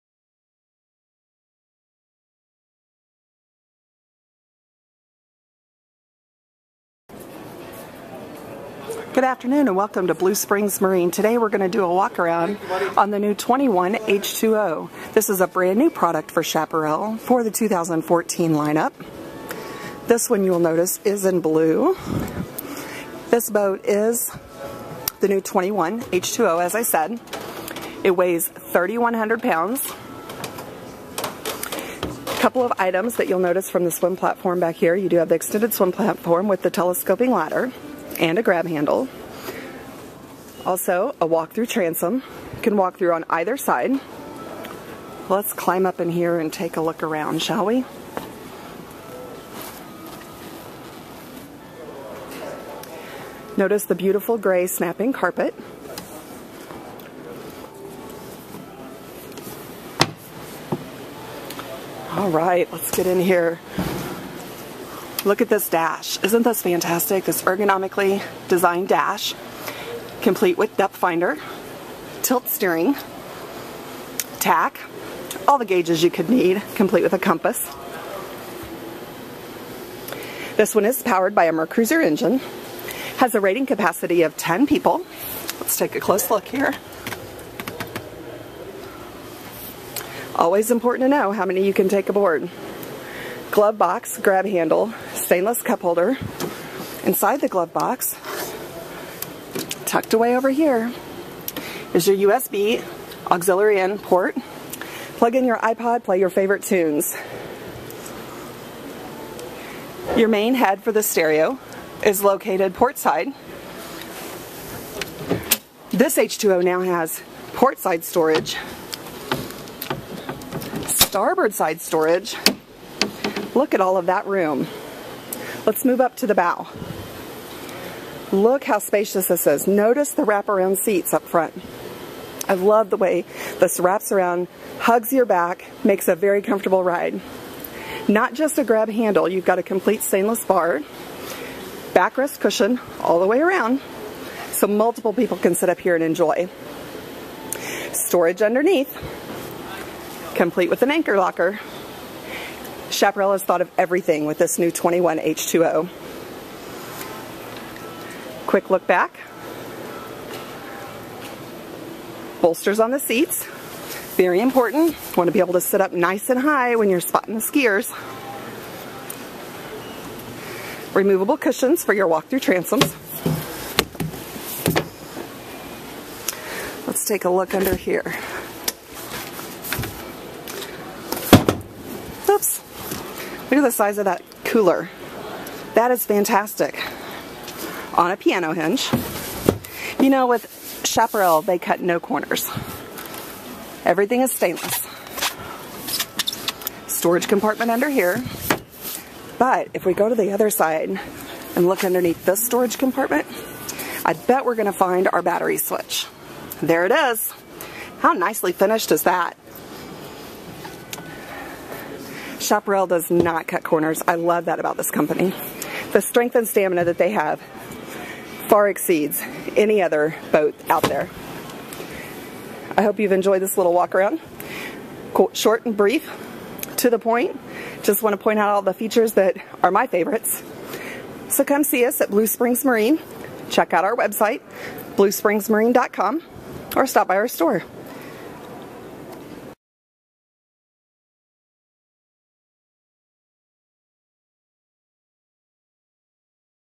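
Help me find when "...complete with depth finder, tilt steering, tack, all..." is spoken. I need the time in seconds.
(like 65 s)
70 s.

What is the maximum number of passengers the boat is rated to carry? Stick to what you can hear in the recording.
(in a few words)
10.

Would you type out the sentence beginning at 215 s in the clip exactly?
The strength and stamina that they have far exceeds any other boat out there.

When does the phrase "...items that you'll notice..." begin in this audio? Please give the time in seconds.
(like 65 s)
32 s.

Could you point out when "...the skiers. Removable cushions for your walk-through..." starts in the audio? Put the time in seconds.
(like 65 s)
167 s.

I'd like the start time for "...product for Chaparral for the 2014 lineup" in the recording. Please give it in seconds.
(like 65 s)
15 s.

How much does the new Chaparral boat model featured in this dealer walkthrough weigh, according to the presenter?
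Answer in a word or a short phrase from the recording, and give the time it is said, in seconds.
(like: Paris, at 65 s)
3,100 pounds, at 28 s.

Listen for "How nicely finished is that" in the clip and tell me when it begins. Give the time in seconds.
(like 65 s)
207 s.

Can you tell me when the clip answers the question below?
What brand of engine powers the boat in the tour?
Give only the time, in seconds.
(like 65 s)
81 s.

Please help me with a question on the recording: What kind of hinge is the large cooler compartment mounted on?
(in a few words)
piano hinge.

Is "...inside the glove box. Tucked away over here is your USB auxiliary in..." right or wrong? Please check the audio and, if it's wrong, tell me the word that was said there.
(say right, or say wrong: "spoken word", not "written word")
right.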